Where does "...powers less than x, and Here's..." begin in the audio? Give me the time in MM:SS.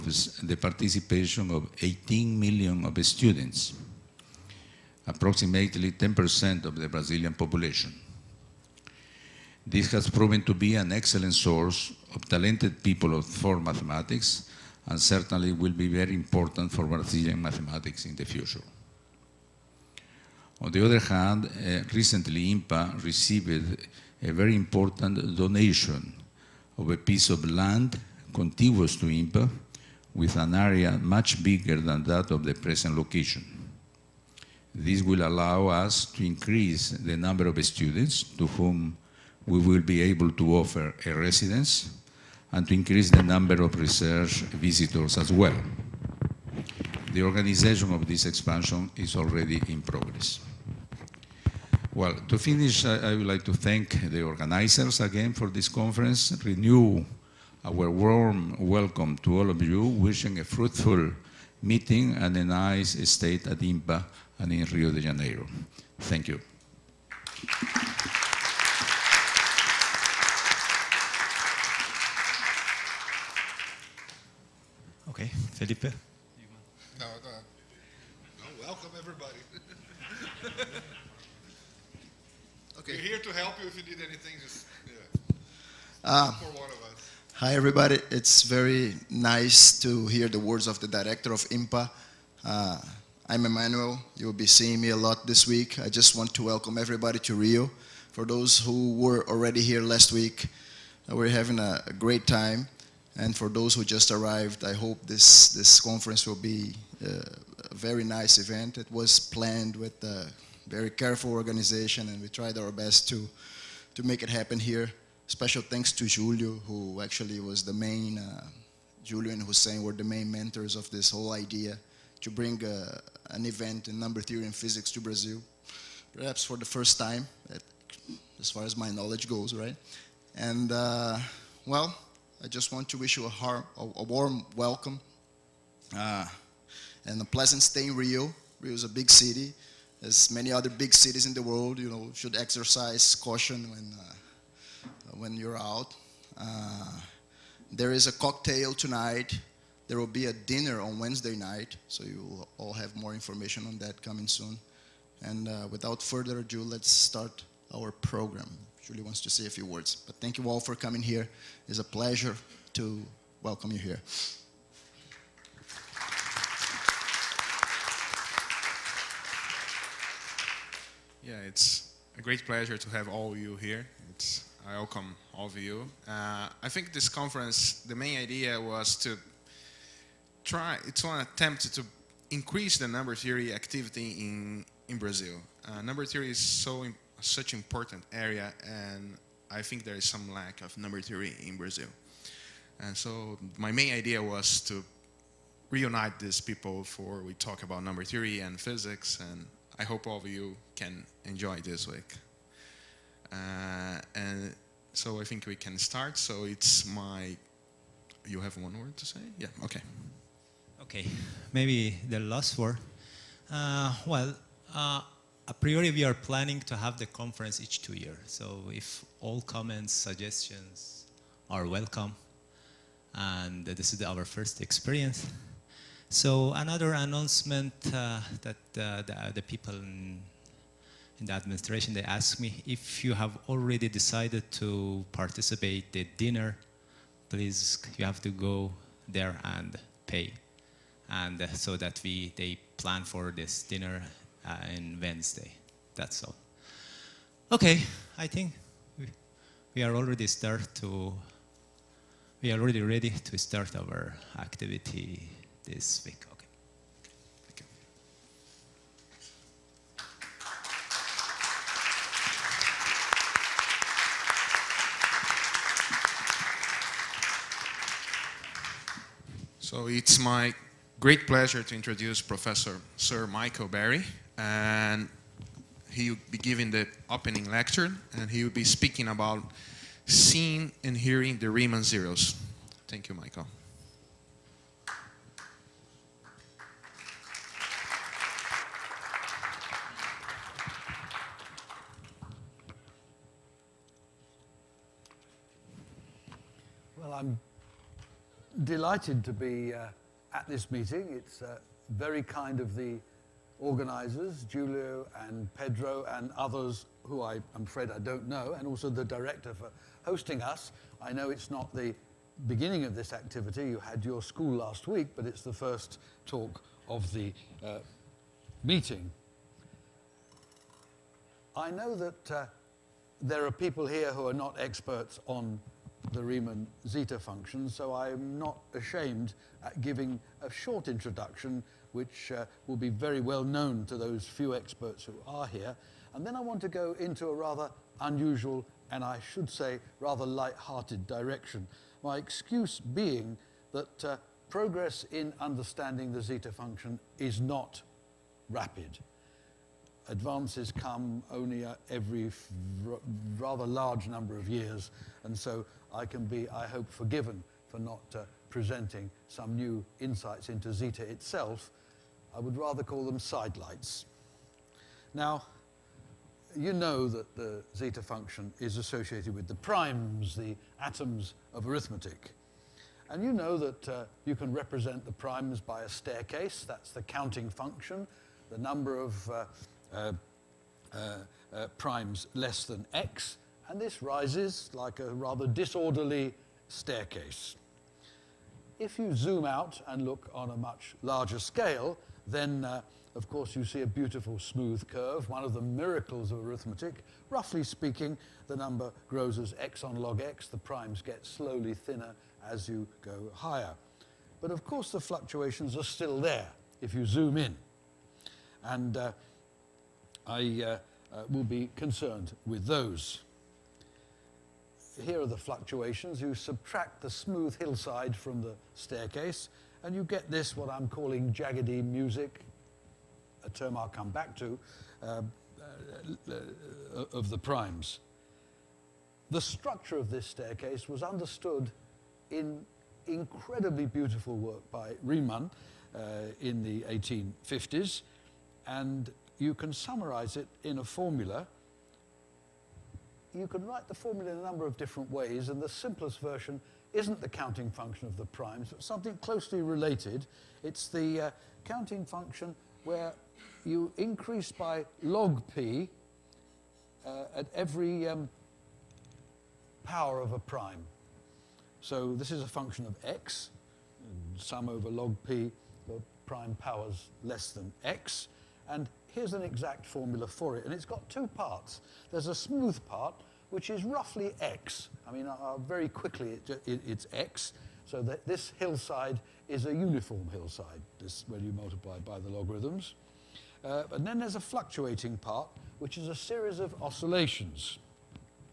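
07:46.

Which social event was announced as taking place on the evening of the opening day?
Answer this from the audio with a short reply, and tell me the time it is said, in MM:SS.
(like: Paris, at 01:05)
A cocktail, at 02:28.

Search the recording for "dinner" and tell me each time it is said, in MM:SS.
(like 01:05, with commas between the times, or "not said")
02:30, 03:56, 04:03.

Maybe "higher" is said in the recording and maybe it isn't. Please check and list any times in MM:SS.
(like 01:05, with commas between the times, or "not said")
06:43.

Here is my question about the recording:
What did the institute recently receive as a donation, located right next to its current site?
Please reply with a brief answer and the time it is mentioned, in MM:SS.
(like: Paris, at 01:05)
A piece of land, at 00:26.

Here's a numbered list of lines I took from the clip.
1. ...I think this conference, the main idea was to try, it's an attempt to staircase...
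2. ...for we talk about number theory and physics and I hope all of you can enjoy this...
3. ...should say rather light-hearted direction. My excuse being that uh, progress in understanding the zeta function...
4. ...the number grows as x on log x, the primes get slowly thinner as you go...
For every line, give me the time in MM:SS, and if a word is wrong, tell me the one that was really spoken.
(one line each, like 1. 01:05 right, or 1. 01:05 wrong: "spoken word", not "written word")
1. 02:56 wrong: "increase", not "staircase"
2. 03:16 right
3. 05:39 right
4. 06:38 right.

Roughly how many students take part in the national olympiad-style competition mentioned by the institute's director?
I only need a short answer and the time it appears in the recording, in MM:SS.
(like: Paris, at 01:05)
18 million, at 00:01.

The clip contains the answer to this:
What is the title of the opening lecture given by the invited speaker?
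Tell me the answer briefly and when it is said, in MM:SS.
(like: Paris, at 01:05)
Seeing and hearing the Riemann zeros, at 04:40.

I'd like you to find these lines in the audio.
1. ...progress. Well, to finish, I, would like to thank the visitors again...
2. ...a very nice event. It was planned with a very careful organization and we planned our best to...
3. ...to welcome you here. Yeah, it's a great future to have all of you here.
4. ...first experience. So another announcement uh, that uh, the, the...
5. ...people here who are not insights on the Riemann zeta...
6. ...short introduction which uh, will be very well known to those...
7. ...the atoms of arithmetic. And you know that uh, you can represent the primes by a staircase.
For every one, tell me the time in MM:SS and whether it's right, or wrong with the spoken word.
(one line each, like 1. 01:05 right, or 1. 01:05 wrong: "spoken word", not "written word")
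1. 00:49 wrong: "organizers", not "visitors"
2. 01:47 wrong: "tried", not "planned"
3. 02:42 wrong: "pleasure", not "future"
4. 03:44 right
5. 05:23 wrong: "experts", not "insights"
6. 05:30 right
7. 06:10 right.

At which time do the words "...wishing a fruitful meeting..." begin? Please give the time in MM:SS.
00:59.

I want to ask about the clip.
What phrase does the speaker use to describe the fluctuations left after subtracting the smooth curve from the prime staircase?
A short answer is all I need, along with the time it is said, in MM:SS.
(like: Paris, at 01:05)
Jaggedy music, at 07:01.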